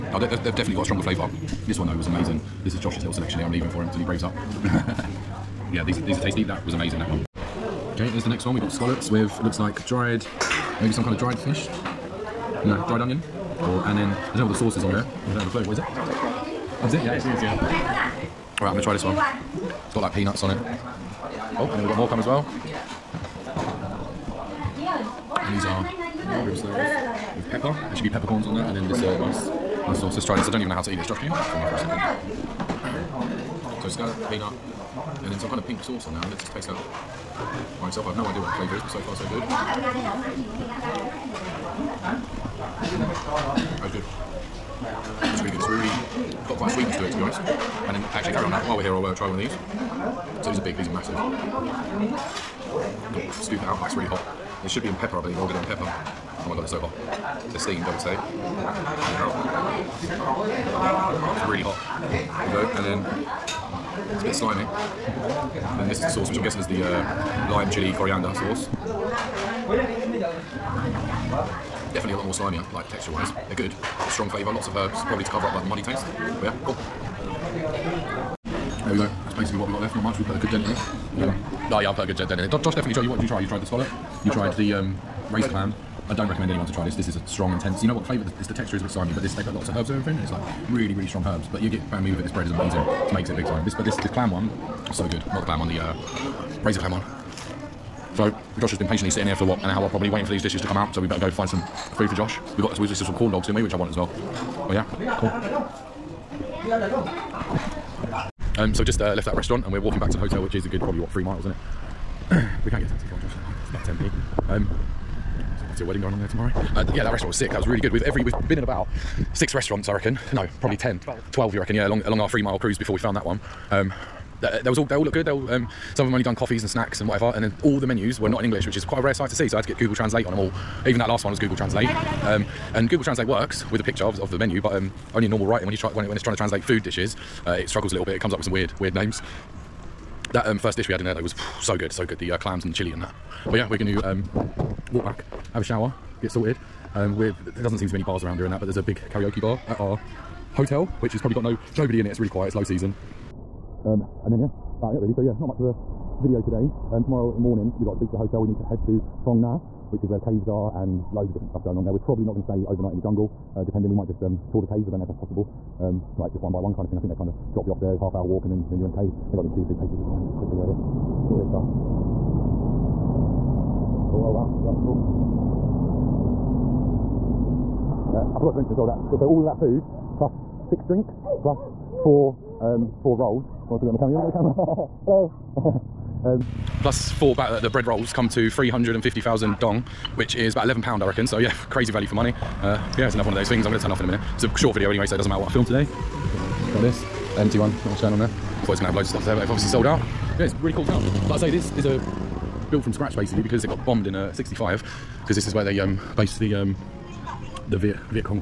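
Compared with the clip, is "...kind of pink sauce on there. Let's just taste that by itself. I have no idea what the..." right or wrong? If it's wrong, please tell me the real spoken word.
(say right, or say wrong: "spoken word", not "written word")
right.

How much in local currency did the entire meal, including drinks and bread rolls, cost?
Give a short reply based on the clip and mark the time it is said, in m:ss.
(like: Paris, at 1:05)
350,000 dong, at 3:08.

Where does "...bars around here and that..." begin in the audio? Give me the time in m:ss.
2:28.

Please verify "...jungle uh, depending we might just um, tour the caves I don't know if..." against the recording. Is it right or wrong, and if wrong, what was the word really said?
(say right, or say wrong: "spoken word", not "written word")
right.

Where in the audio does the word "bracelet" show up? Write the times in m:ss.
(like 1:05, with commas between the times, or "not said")
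not said.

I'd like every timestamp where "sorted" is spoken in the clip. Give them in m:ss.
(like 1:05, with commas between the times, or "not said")
2:26.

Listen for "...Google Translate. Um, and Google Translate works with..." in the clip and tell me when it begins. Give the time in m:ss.
2:11.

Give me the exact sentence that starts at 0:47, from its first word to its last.
And then actually carry on now.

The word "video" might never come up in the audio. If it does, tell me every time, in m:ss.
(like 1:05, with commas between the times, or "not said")
2:36, 2:50, 3:14.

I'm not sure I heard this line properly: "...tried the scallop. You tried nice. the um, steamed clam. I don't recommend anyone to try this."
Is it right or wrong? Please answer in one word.
wrong.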